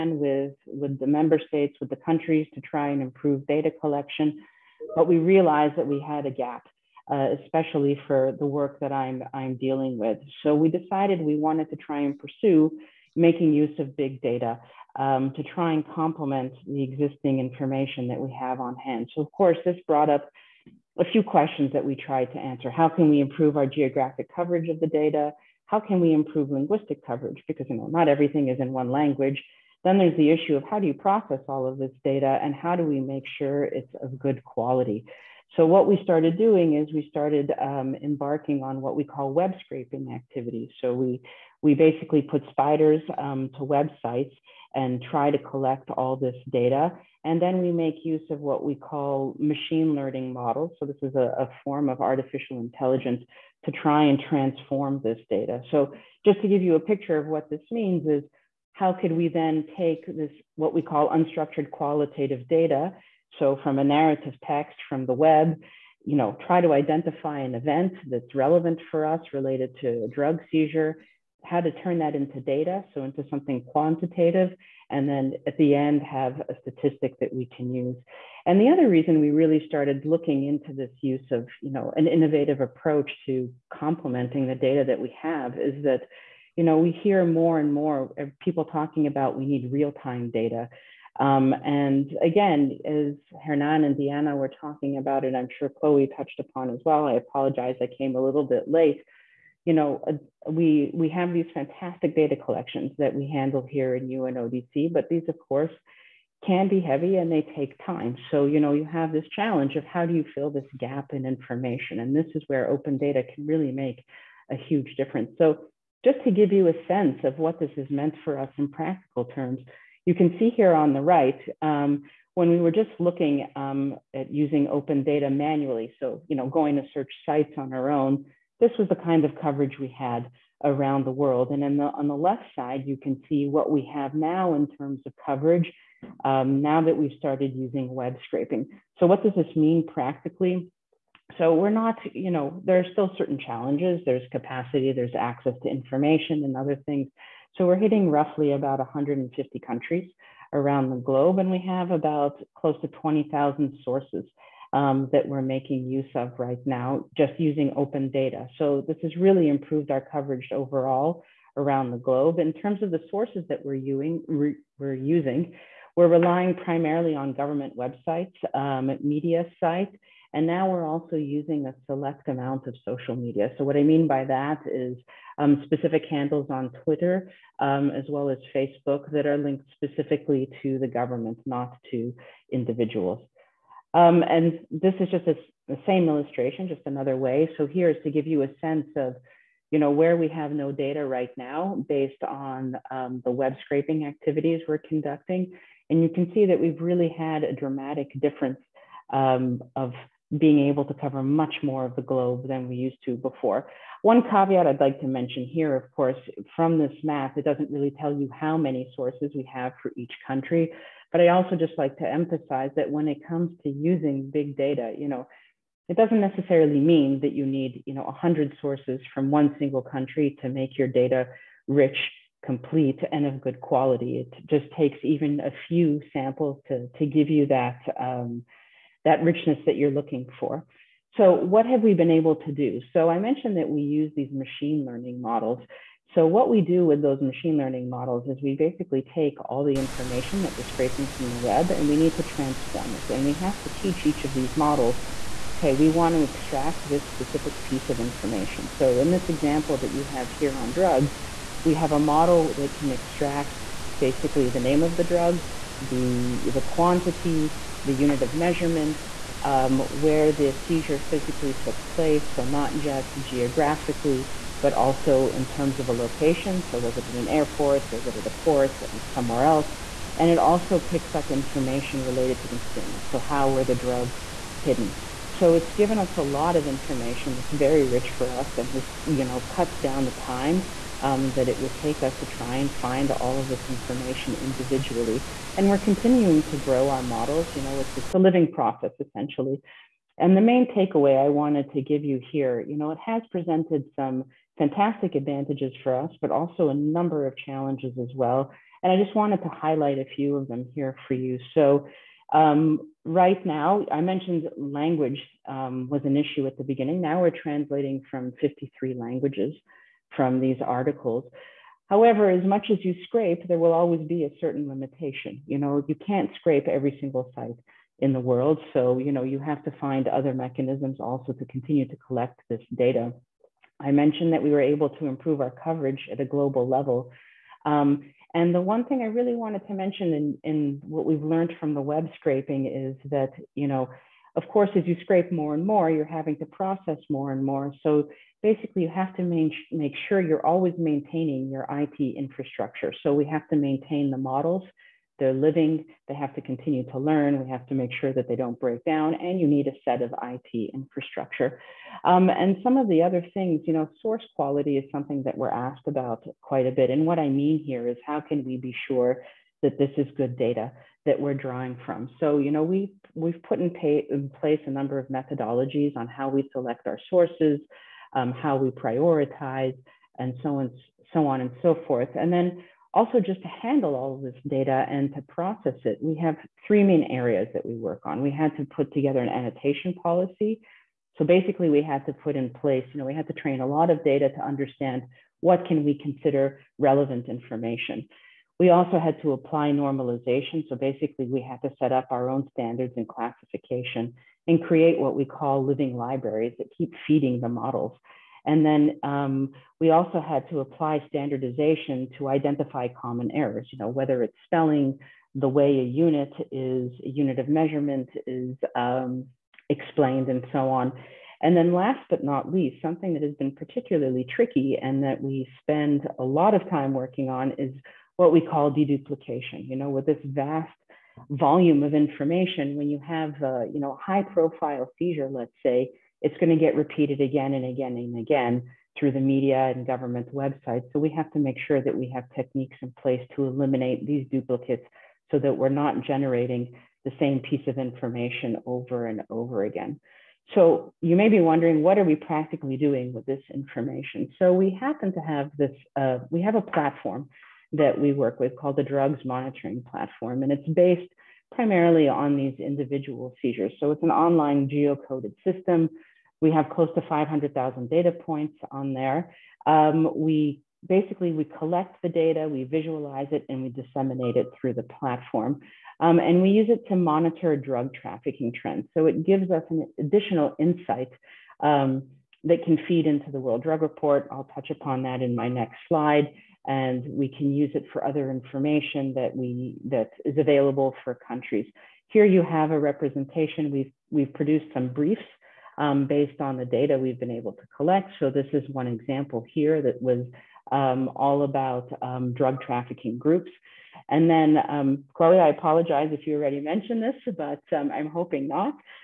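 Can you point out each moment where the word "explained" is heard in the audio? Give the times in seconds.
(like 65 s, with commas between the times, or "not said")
409 s.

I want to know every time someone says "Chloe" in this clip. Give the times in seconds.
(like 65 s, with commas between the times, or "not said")
95 s, 495 s.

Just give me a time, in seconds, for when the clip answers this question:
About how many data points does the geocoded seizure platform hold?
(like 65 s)
457 s.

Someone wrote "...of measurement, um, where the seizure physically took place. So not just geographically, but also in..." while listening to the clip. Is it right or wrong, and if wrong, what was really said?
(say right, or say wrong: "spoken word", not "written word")
right.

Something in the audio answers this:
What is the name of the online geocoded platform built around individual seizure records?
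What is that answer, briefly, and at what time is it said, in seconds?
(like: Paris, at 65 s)
Drugs Monitoring Platform, at 448 s.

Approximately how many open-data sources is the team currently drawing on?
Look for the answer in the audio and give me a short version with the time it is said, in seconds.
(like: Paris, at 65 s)
20,000, at 152 s.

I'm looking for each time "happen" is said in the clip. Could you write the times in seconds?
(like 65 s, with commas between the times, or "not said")
444 s.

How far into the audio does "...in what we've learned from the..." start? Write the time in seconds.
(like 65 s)
330 s.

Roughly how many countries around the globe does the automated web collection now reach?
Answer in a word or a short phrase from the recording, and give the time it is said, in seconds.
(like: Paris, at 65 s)
150, at 148 s.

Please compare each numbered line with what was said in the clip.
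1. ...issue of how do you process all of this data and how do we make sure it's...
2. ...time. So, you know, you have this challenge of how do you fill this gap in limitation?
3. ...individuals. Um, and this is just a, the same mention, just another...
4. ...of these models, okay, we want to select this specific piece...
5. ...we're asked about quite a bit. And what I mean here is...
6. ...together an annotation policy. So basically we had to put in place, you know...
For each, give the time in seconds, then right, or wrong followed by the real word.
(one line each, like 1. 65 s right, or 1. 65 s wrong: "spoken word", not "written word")
1. 30 s right
2. 107 s wrong: "information", not "limitation"
3. 182 s wrong: "illustration", not "mention"
4. 244 s wrong: "extract", not "select"
5. 355 s right
6. 378 s right.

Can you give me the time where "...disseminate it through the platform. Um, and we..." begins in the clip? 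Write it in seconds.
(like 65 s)
463 s.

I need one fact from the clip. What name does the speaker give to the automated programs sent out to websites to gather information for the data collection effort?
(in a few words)
spiders.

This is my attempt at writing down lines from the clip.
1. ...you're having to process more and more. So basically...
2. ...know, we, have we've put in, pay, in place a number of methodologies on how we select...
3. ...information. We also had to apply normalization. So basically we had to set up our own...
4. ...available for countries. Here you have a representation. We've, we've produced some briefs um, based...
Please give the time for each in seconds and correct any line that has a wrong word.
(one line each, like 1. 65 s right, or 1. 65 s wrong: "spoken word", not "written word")
1. 335 s right
2. 362 s right
3. 387 s right
4. 480 s right.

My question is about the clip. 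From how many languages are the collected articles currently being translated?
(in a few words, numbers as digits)
53.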